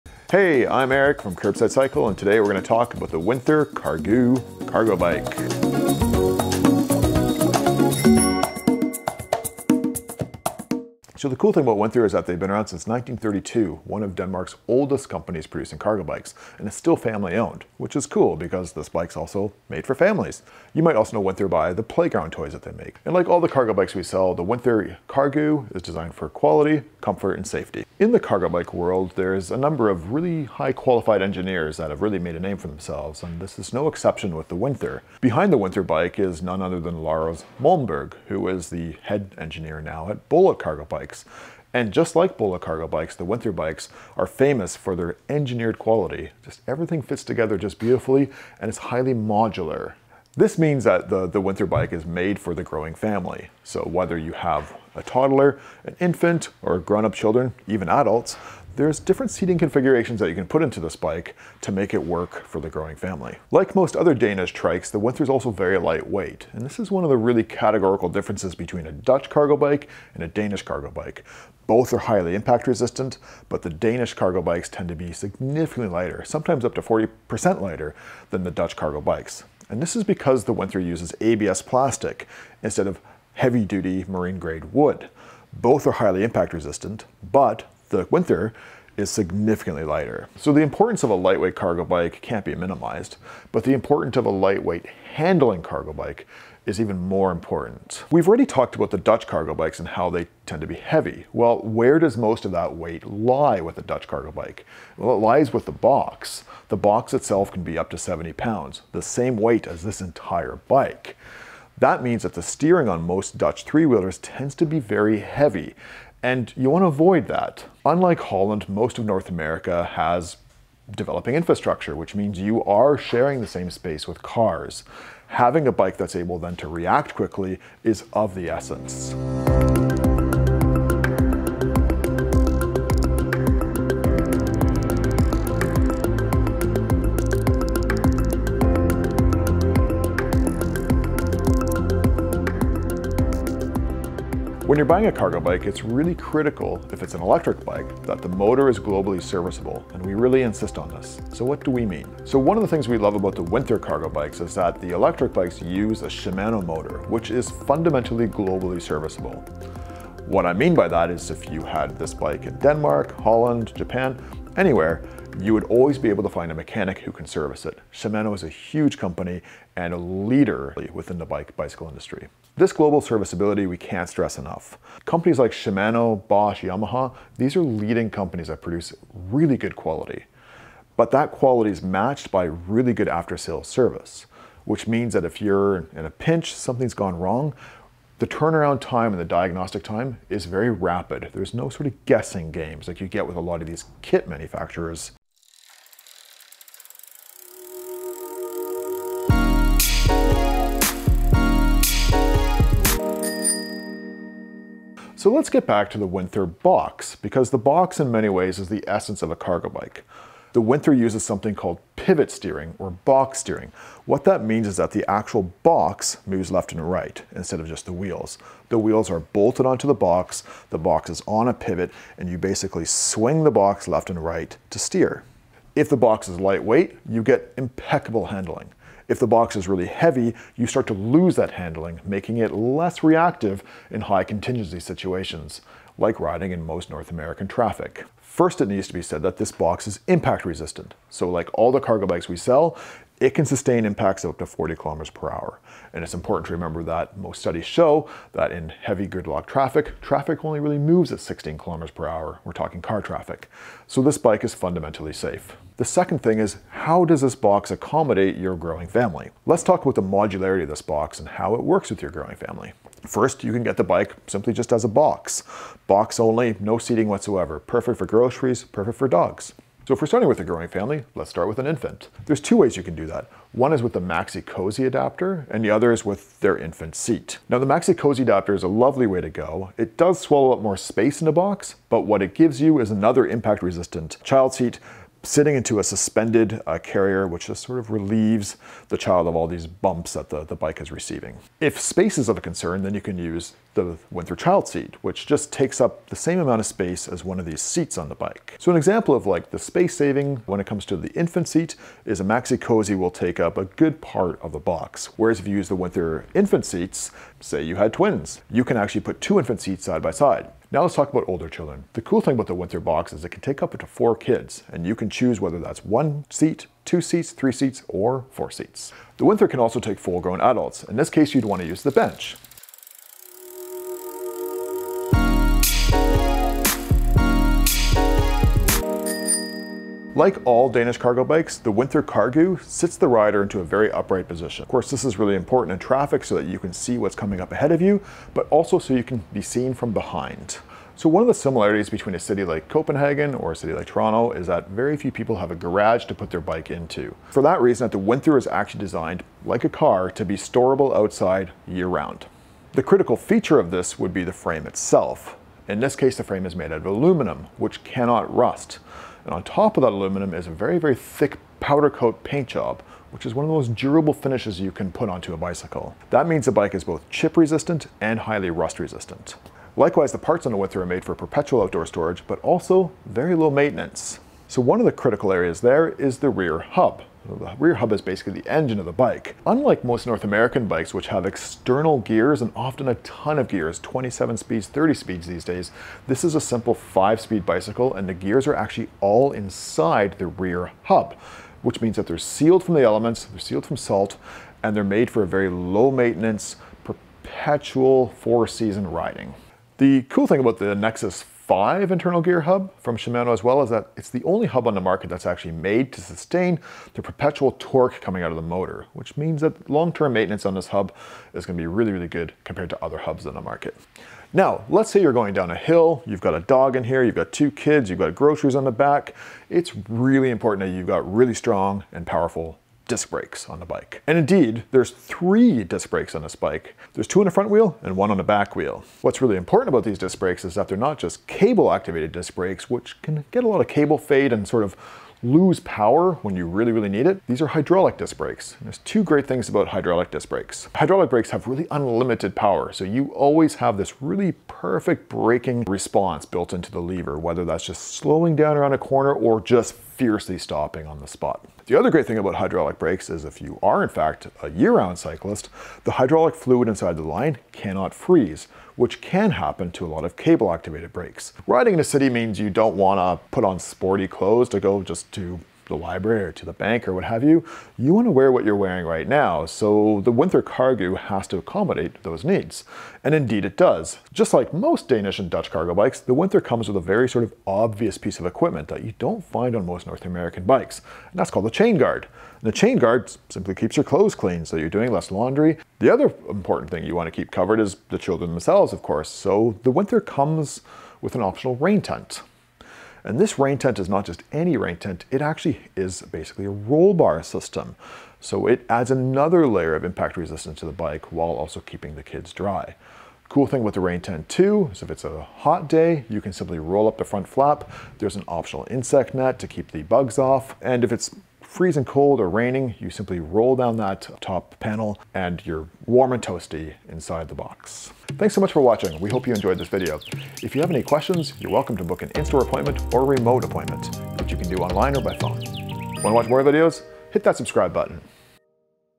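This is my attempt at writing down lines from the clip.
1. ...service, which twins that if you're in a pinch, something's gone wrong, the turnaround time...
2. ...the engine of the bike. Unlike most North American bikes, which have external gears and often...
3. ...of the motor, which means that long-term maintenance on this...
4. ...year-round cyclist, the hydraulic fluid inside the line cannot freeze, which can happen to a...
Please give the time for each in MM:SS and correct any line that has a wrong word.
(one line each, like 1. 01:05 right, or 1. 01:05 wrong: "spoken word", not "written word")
1. 03:03 wrong: "means", not "twins"
2. 06:18 right
3. 06:48 right
4. 07:34 right.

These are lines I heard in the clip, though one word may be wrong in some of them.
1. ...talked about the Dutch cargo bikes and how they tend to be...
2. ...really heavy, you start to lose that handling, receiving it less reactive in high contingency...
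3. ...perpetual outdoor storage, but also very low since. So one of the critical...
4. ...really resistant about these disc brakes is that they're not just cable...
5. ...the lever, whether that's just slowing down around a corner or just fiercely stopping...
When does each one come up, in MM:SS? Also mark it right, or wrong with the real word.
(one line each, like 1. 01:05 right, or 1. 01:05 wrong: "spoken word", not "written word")
1. 01:38 right
2. 03:49 wrong: "making", not "receiving"
3. 06:11 wrong: "maintenance", not "since"
4. 07:09 wrong: "important", not "resistant"
5. 07:26 right.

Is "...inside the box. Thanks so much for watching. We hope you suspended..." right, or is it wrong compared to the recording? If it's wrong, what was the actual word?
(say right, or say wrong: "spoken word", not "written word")
wrong: "enjoyed", not "suspended".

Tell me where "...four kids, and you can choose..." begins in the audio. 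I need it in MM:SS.
05:13.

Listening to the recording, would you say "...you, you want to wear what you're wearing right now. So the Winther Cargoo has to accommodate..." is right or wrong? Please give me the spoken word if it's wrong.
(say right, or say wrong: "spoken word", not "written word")
right.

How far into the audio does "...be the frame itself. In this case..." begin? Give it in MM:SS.
05:54.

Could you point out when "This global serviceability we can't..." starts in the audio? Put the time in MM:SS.
02:52.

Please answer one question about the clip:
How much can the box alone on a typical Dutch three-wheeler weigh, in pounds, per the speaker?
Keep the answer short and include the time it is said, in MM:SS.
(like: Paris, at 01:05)
70 pounds, at 01:47.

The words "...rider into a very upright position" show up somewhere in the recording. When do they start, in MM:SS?
05:33.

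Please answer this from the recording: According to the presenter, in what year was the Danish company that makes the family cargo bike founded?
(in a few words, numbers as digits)
1932.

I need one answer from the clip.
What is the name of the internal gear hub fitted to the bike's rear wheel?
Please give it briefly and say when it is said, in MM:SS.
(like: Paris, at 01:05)
Nexus 5, at 06:40.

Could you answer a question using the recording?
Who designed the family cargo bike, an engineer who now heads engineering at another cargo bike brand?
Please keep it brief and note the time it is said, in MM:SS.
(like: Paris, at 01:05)
Lars Malmberg, at 00:37.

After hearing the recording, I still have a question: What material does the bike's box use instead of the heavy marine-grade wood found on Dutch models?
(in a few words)
ABS plastic.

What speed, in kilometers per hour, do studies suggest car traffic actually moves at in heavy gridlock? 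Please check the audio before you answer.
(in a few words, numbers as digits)
16 km/h.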